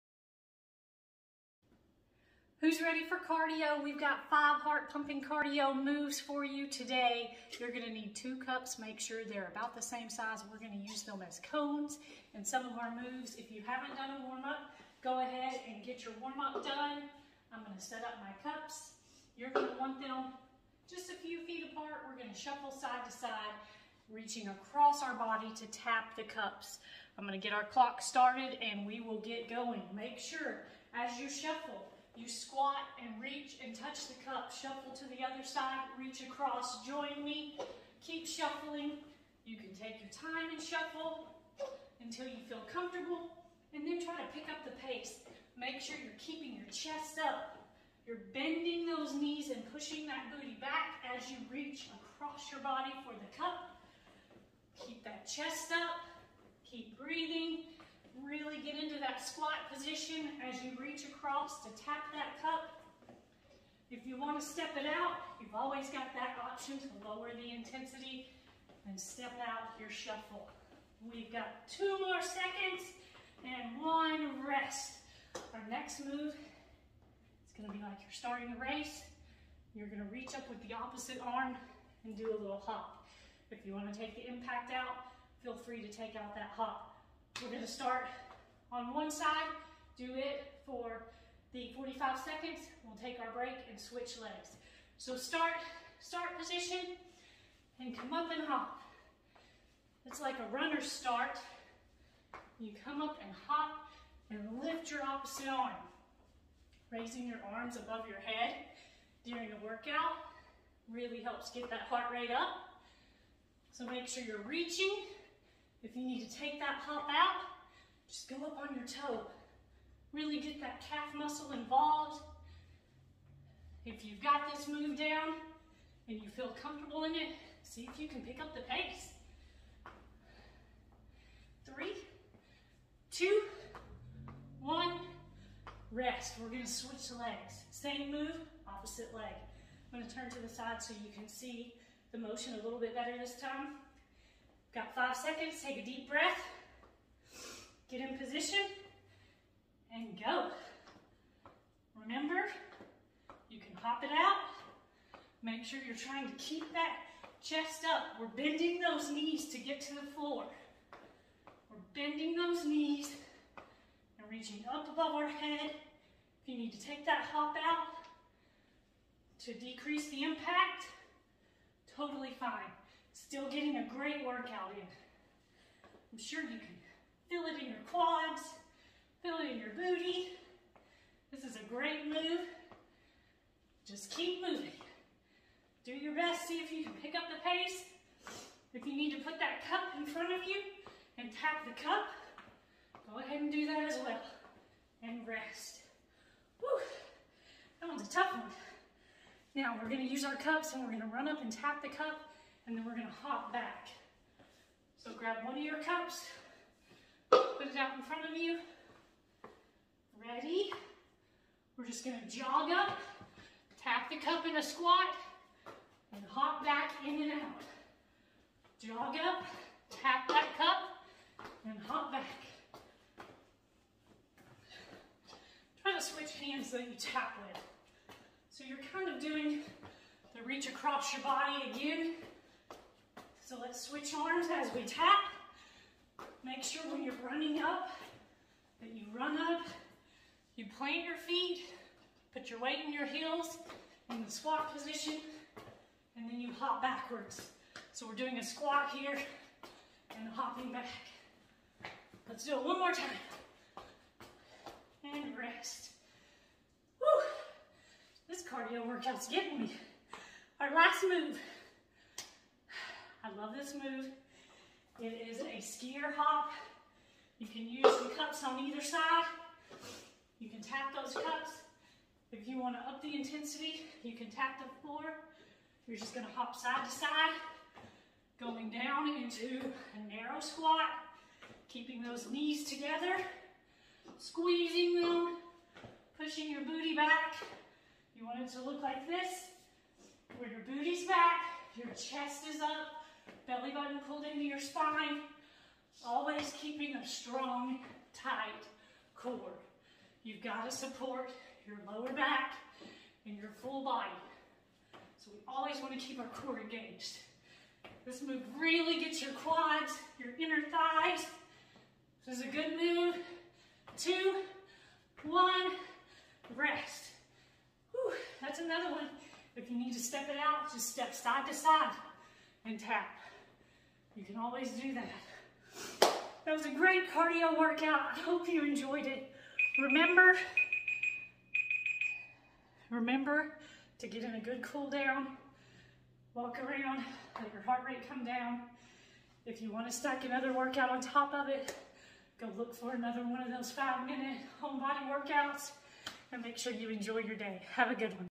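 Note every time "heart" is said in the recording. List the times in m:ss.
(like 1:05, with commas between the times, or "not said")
0:04, 1:51, 5:37.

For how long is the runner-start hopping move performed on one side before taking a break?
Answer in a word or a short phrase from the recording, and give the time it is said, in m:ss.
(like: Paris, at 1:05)
45 seconds, at 1:31.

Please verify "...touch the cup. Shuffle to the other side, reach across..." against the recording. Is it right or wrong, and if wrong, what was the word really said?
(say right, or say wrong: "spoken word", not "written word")
right.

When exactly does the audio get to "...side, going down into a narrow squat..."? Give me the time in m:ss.
4:36.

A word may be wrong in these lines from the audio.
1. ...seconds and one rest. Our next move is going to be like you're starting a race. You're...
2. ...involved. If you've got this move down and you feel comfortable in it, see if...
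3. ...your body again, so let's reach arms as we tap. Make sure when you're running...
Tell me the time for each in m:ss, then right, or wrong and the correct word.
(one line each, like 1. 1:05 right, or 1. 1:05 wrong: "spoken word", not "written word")
1. 1:12 right
2. 2:01 right
3. 3:51 wrong: "switch", not "reach".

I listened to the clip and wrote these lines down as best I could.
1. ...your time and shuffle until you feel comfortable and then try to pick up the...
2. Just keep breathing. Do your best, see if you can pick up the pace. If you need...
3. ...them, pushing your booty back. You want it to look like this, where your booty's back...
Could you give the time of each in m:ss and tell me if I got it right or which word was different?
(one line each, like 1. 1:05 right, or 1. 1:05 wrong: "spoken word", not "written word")
1. 0:40 right
2. 3:03 wrong: "moving", not "breathing"
3. 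4:45 right.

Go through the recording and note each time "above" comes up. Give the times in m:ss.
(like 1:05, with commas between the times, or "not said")
1:47, 2:44.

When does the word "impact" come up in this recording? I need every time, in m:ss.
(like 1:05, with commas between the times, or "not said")
1:24, 2:50.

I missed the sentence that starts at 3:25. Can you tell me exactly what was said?
So grab one of your cups, put it out in front of you.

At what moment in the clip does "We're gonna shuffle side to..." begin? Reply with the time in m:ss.
0:22.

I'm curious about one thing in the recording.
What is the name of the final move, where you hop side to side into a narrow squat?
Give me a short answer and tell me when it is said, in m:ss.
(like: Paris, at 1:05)
Skier hop, at 4:25.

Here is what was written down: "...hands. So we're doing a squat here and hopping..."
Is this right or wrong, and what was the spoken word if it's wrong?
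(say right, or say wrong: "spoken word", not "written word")
wrong: "backwards", not "hands".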